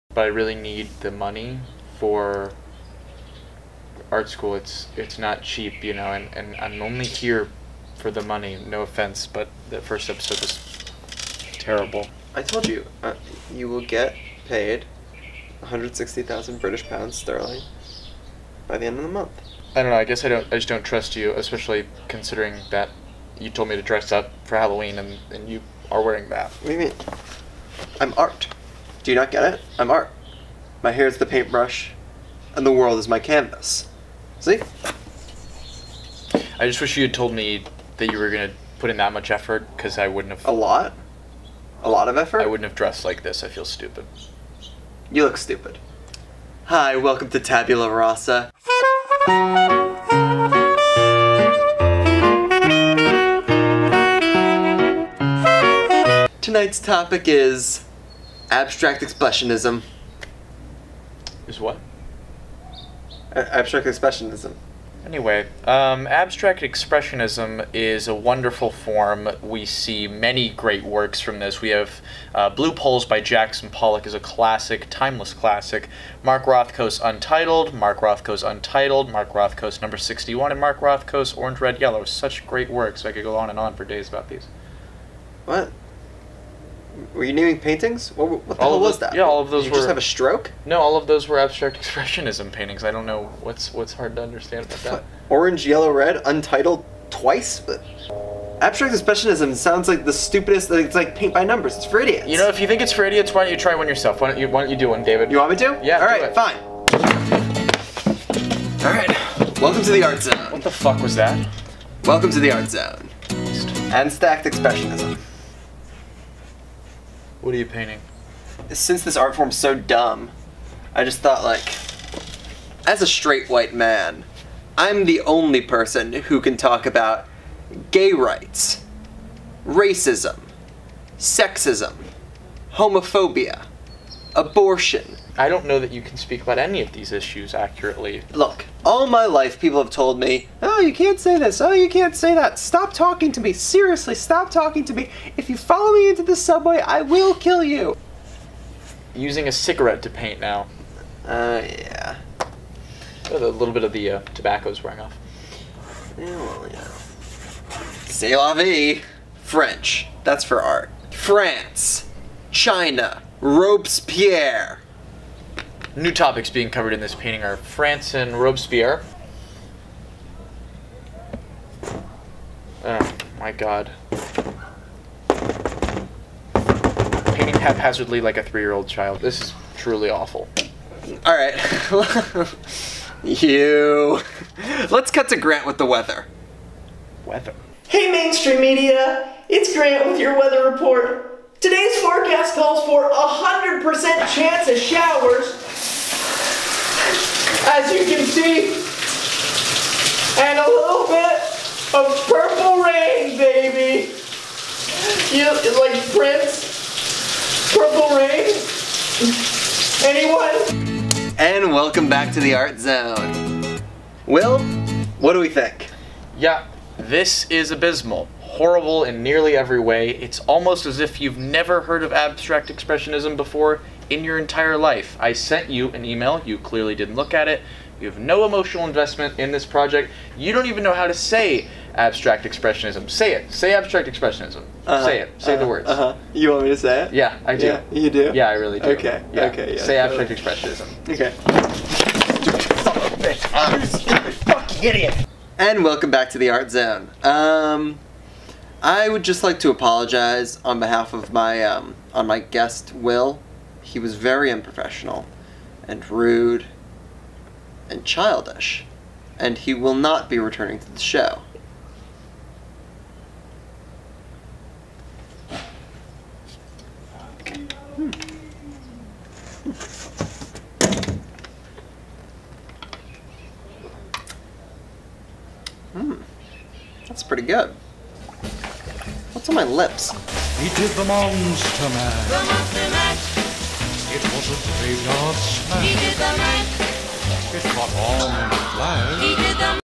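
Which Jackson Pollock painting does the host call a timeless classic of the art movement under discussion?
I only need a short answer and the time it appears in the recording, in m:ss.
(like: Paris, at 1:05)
Blue Poles, at 1:12.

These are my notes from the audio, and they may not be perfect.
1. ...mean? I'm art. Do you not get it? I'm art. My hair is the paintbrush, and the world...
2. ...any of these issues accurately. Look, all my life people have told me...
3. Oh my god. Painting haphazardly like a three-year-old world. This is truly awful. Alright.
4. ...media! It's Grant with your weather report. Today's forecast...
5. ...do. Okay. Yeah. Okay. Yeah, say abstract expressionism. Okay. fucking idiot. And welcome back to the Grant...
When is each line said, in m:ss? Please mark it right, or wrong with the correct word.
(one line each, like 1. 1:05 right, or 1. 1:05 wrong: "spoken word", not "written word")
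1. 0:26 right
2. 2:16 right
3. 2:52 wrong: "child", not "world"
4. 3:08 right
5. 3:58 wrong: "Art", not "Grant".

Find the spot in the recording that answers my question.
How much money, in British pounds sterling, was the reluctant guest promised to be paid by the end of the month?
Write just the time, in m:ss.
0:15.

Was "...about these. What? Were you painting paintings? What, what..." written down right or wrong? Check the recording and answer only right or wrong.
wrong.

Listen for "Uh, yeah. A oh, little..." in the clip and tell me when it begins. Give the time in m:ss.
2:31.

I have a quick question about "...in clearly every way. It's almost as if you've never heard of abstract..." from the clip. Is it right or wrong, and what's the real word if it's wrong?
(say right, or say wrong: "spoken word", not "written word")
wrong: "nearly", not "clearly".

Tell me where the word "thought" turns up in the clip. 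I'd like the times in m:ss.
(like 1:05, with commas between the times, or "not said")
2:01.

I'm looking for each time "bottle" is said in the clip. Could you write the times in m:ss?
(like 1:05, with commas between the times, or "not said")
not said.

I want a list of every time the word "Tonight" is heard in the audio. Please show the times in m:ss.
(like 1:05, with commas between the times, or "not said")
0:56.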